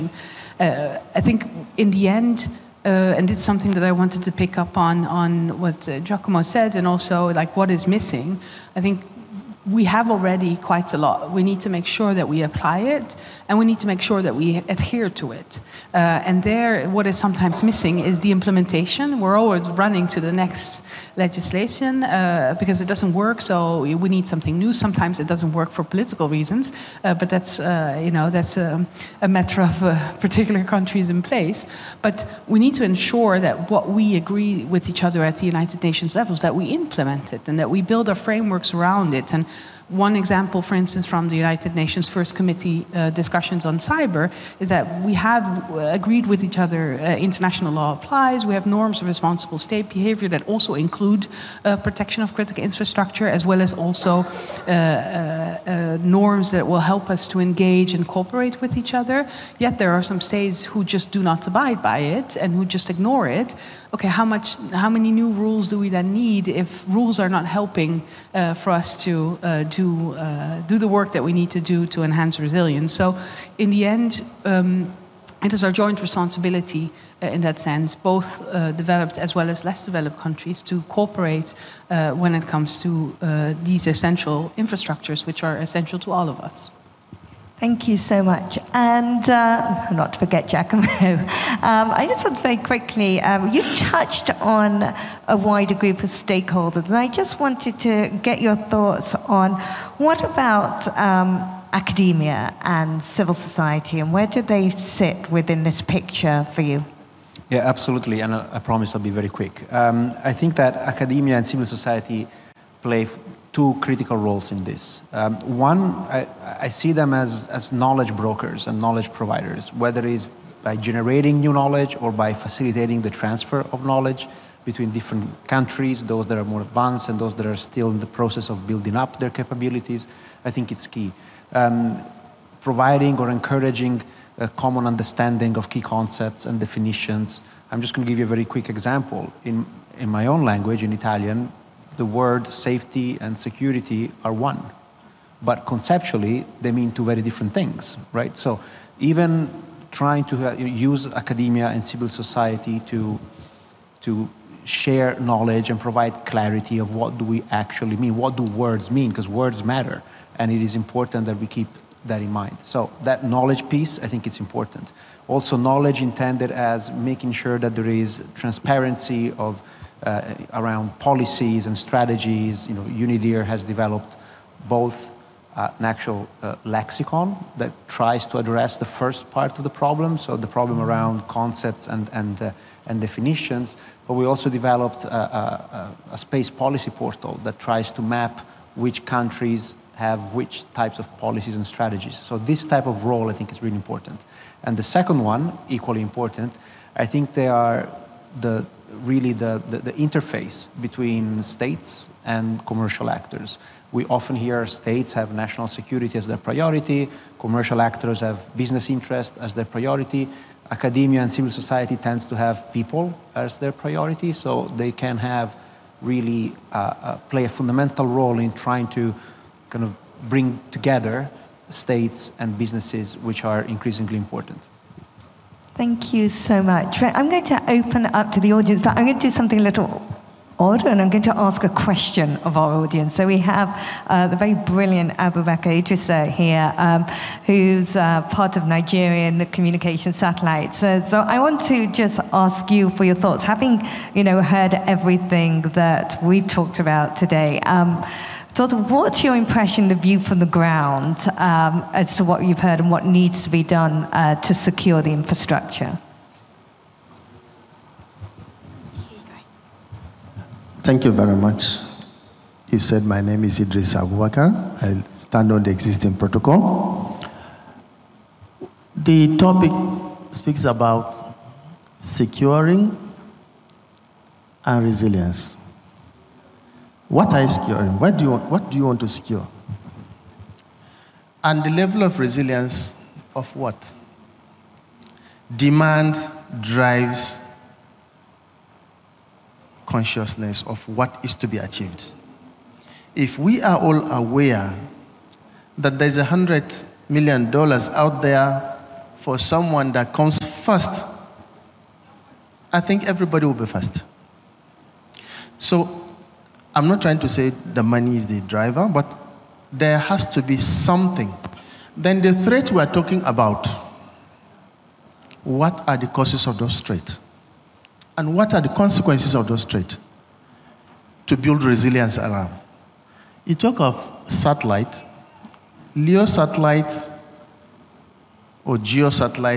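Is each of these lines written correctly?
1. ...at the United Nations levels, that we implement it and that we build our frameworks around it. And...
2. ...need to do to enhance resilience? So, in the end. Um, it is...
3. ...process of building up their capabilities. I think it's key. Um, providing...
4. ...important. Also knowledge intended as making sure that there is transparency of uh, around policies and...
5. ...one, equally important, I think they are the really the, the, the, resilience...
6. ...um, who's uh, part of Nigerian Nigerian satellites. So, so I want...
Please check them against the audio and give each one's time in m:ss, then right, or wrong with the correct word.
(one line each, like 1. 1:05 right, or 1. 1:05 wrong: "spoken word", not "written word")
1. 0:35 right
2. 1:11 right
3. 2:08 right
4. 2:44 right
5. 3:15 wrong: "interface", not "resilience"
6. 3:56 wrong: "Communication", not "Nigerian".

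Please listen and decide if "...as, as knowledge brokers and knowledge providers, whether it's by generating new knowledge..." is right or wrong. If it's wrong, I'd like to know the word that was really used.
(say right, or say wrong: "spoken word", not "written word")
right.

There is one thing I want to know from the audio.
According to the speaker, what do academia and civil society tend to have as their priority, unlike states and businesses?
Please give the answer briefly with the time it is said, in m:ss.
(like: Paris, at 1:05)
people, at 3:32.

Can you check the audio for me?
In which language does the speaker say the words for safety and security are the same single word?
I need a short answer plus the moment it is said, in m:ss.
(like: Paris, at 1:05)
Italian, at 2:20.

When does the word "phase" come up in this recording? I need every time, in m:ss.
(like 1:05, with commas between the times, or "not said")
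not said.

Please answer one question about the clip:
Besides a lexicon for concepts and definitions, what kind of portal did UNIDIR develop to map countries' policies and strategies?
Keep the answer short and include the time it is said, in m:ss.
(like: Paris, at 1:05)
space policy portal, at 3:06.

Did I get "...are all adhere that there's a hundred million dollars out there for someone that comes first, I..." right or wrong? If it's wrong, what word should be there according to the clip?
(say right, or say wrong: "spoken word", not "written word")
wrong: "aware", not "adhere".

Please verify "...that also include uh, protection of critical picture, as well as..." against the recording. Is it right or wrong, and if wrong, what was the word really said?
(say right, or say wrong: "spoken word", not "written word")
wrong: "infrastructure", not "picture".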